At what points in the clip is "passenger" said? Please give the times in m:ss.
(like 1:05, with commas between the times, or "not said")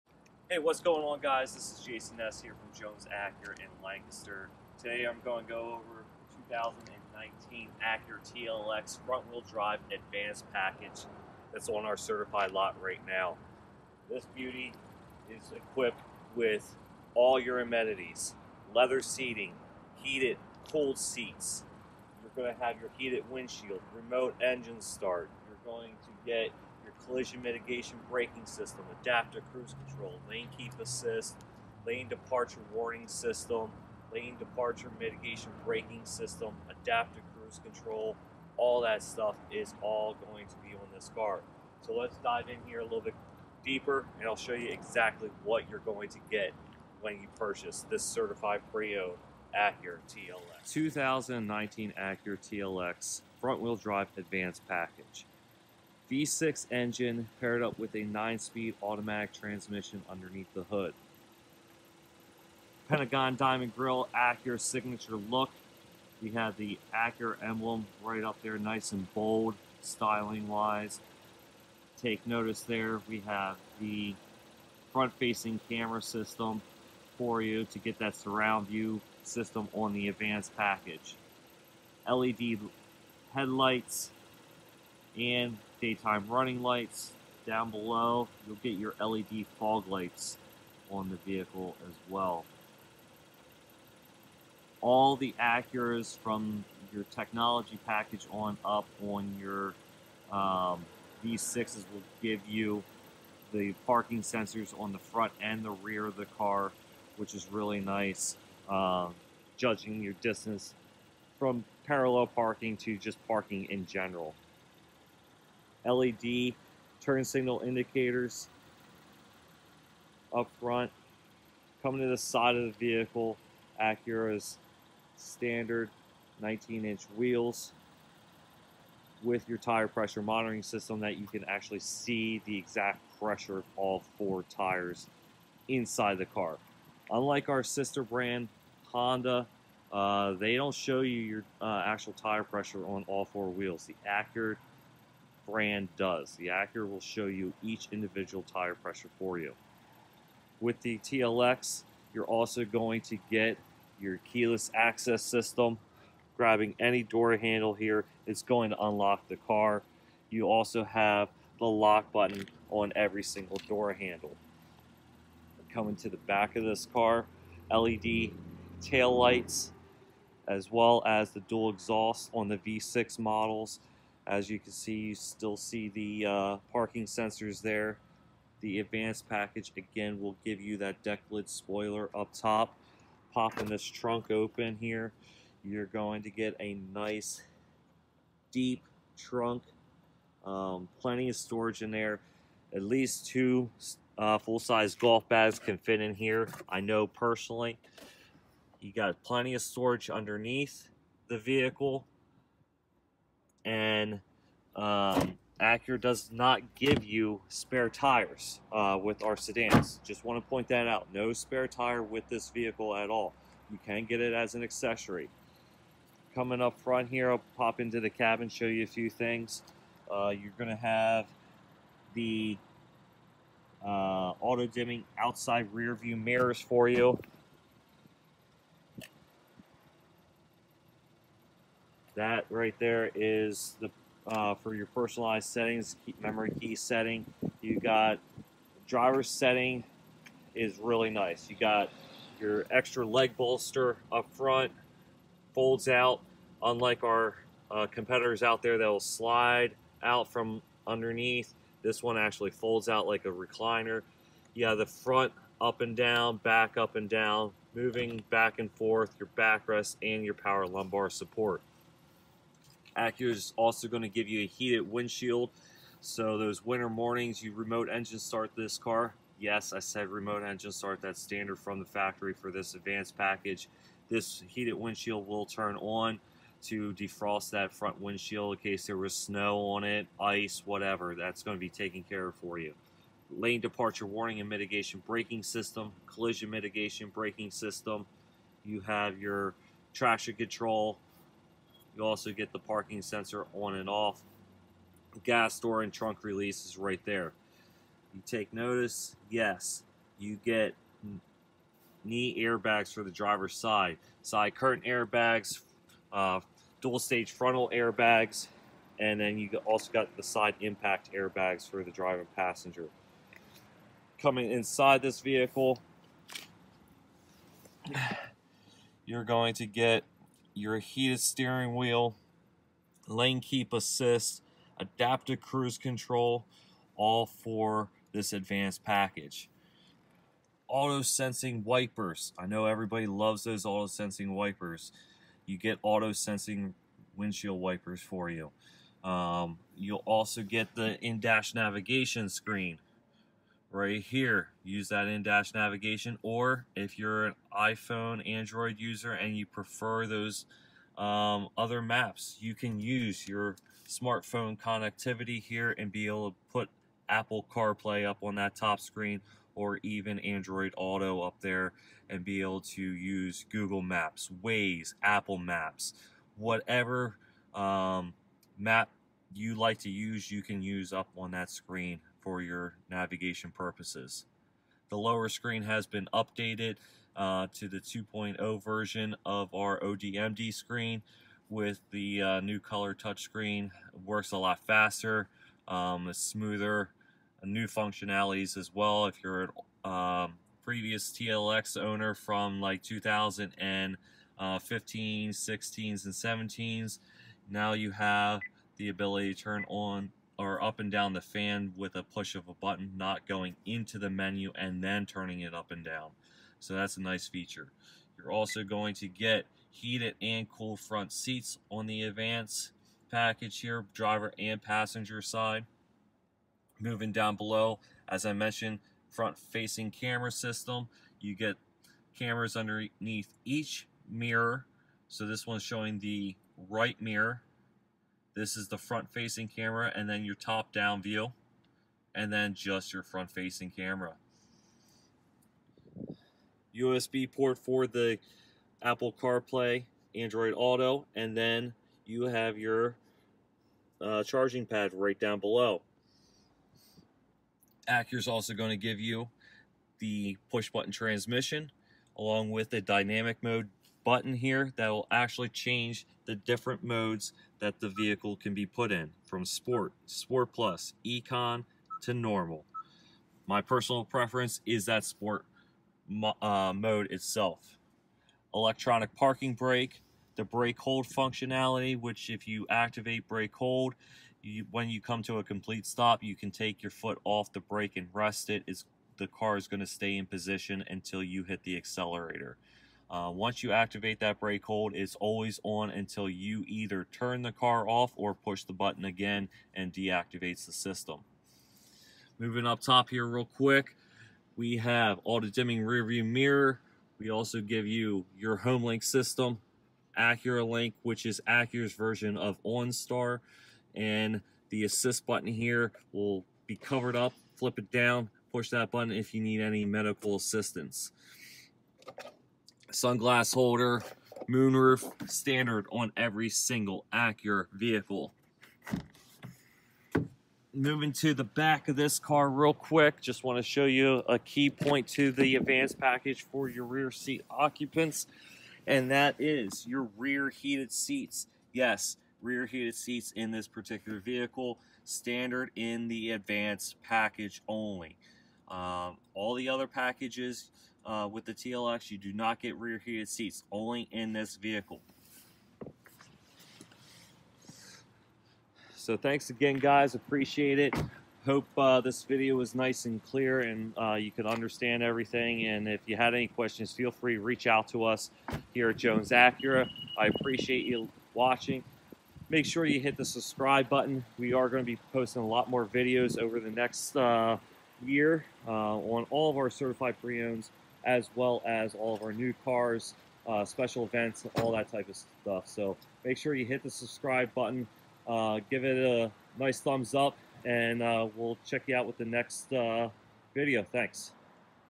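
5:12, 6:54.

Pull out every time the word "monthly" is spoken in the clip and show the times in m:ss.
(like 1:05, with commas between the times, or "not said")
not said.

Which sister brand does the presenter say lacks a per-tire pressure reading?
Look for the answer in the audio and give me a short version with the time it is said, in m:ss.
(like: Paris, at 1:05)
Honda, at 2:18.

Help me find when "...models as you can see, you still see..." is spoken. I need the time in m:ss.
2:53.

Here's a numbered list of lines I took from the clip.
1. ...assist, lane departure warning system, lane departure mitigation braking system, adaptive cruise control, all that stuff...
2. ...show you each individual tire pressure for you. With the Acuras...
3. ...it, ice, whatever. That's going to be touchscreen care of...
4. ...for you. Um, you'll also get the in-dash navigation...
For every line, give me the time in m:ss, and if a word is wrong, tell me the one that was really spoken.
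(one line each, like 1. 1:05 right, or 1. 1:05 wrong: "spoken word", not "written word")
1. 0:30 right
2. 2:27 wrong: "TLX", not "Acuras"
3. 4:39 wrong: "taken", not "touchscreen"
4. 5:38 right.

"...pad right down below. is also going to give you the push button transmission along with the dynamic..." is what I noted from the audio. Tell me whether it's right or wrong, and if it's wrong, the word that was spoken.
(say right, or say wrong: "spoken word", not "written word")
right.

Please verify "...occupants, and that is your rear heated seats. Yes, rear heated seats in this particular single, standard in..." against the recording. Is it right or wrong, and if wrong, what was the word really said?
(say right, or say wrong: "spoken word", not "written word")
wrong: "vehicle", not "single".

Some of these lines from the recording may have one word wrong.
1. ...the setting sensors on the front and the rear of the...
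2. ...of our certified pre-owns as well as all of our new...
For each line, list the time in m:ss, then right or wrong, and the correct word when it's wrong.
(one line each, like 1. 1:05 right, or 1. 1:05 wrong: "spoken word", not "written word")
1. 1:43 wrong: "parking", not "setting"
2. 9:29 right.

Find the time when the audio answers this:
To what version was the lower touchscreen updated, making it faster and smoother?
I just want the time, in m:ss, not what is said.
6:17.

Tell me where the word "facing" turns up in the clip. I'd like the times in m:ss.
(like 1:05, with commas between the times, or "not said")
1:14, 6:59, 7:09, 7:13.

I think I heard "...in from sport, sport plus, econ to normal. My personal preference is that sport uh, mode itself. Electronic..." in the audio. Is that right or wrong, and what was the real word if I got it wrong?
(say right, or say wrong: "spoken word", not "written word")
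right.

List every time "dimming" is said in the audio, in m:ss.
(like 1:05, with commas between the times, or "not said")
3:44, 8:15.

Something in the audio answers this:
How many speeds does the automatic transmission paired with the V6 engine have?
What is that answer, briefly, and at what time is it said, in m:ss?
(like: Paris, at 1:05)
9, at 0:58.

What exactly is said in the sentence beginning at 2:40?
You also have the lock button on every single door handle.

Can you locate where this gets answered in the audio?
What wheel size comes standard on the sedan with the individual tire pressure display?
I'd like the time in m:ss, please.
2:06.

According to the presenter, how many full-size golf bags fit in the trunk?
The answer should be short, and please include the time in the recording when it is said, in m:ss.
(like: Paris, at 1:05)
2, at 3:13.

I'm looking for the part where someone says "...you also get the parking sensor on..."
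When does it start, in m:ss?
4:51.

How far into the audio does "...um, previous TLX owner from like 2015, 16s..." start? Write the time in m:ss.
6:29.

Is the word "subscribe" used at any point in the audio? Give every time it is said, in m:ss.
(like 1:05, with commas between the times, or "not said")
9:23, 9:36.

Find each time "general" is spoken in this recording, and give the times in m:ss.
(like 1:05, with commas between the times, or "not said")
1:53.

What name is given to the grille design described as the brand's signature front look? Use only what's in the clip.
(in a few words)
Pentagon Diamond Grill.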